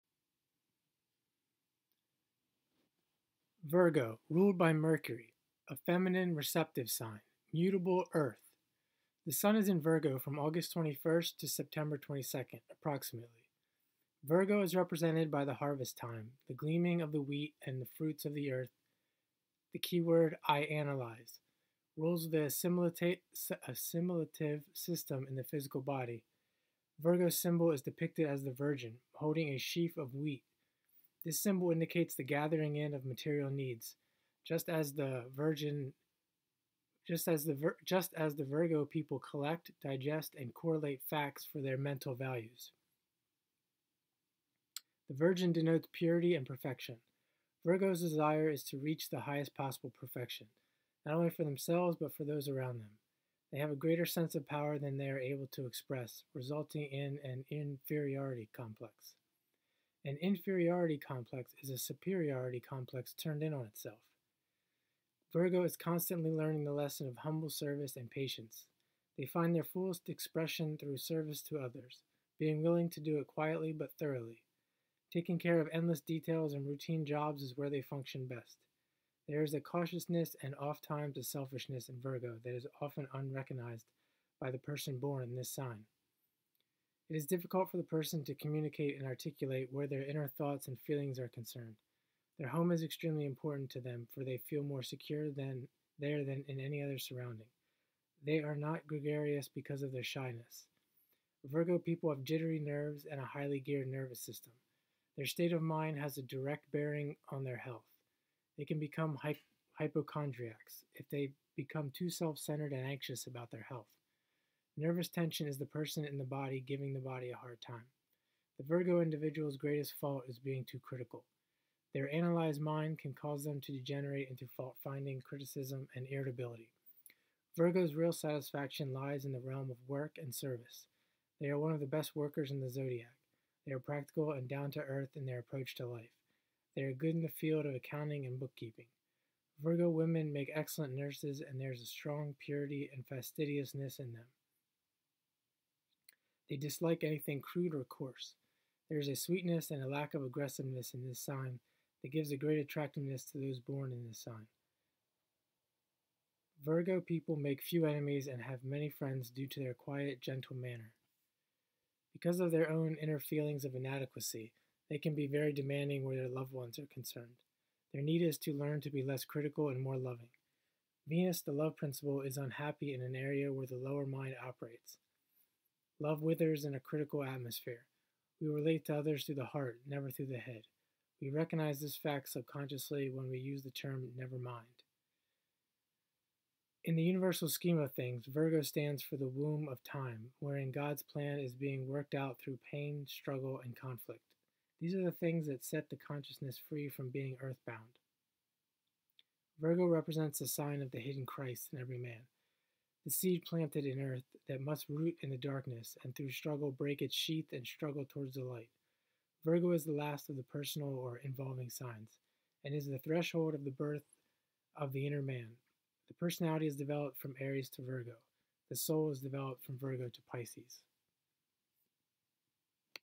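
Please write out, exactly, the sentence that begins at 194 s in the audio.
These are the things that set the consciousness free from being earthbound.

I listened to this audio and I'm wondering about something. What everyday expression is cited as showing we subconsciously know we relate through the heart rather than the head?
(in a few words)
Never mind.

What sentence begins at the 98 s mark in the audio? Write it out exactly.
They are not gregarious because of their shyness.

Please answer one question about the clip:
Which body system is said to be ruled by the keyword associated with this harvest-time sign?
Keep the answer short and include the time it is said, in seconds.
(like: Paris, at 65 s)
Assimilative system, at 23 s.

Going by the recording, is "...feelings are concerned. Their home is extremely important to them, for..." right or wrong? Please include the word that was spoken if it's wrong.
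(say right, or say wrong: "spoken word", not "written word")
right.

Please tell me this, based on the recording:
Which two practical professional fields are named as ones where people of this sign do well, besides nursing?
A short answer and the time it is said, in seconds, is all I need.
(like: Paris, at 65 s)
Accounting and bookkeeping, at 137 s.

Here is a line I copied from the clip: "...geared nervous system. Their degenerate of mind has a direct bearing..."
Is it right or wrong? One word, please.
wrong.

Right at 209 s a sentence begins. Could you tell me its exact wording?
Virgo is the last of the personal or involving signs and is the threshold of the birth of the inner man.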